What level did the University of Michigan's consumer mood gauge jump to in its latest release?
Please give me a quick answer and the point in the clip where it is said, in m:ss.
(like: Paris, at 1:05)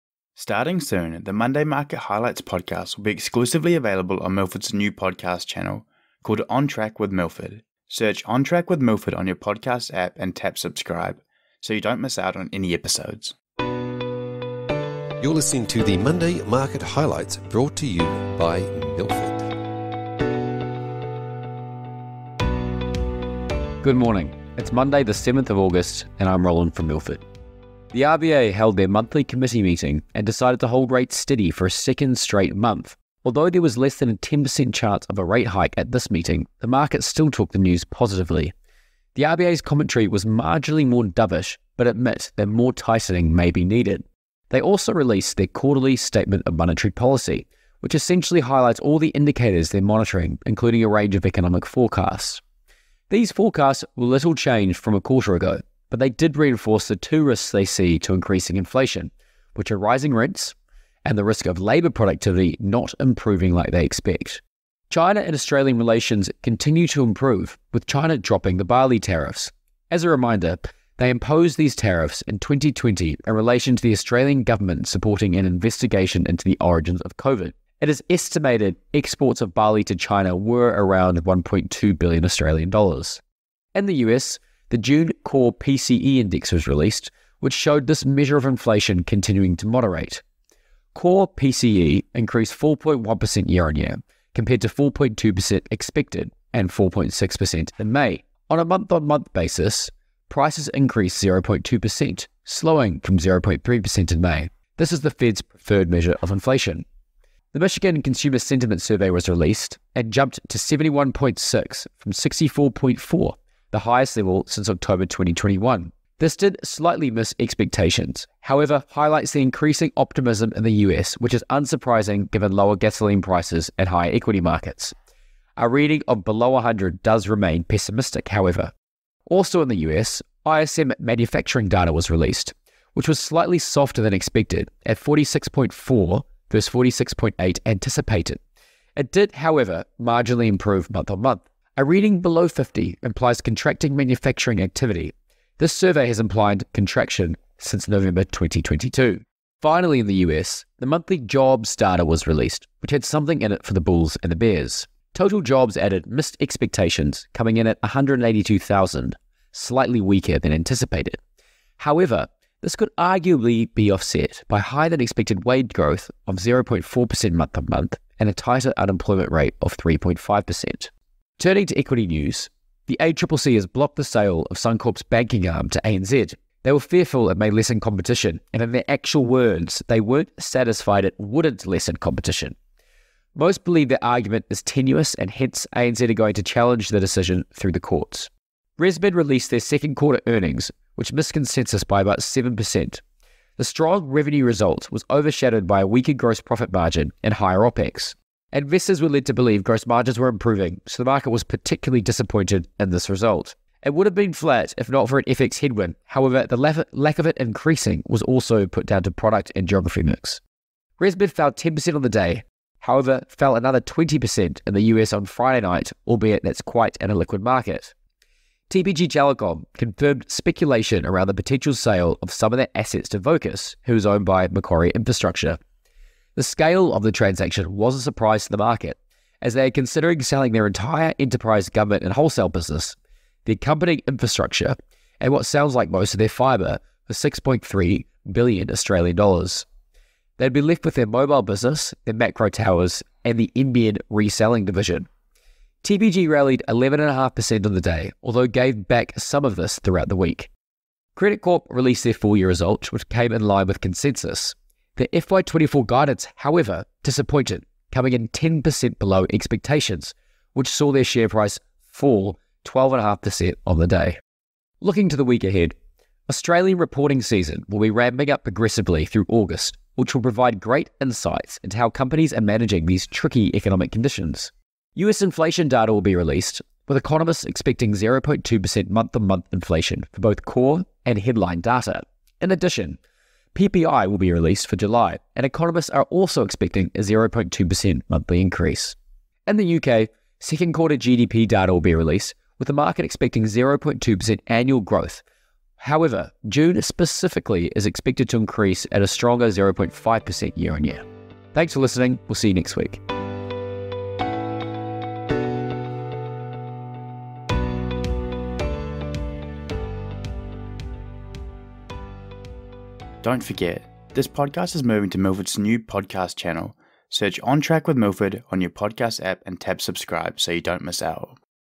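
71.6, at 1:50.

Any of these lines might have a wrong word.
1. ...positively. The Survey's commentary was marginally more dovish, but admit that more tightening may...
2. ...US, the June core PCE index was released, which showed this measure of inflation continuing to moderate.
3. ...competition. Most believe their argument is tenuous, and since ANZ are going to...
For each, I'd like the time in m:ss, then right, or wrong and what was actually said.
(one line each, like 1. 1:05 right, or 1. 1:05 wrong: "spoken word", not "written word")
1. 0:37 wrong: "RBA", not "Survey"
2. 1:24 right
3. 3:01 wrong: "hence", not "since".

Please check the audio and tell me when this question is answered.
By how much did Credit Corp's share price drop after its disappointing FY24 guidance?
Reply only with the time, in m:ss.
4:22.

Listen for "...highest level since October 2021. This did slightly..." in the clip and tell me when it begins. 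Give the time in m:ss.
1:53.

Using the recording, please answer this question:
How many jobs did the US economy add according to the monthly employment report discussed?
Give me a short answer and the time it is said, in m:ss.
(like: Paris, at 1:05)
182,000, at 2:37.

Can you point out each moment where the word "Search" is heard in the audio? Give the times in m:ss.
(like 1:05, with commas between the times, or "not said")
0:07, 5:17.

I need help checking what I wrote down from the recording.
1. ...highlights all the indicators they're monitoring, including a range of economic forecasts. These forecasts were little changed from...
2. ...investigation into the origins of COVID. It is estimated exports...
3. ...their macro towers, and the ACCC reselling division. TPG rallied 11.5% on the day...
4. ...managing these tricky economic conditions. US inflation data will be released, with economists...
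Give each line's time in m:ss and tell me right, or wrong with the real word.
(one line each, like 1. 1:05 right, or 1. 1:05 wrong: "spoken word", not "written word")
1. 0:48 right
2. 1:15 right
3. 4:02 wrong: "NBN", not "ACCC"
4. 4:32 right.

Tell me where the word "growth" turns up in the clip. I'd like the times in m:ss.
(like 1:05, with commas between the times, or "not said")
2:45, 4:54.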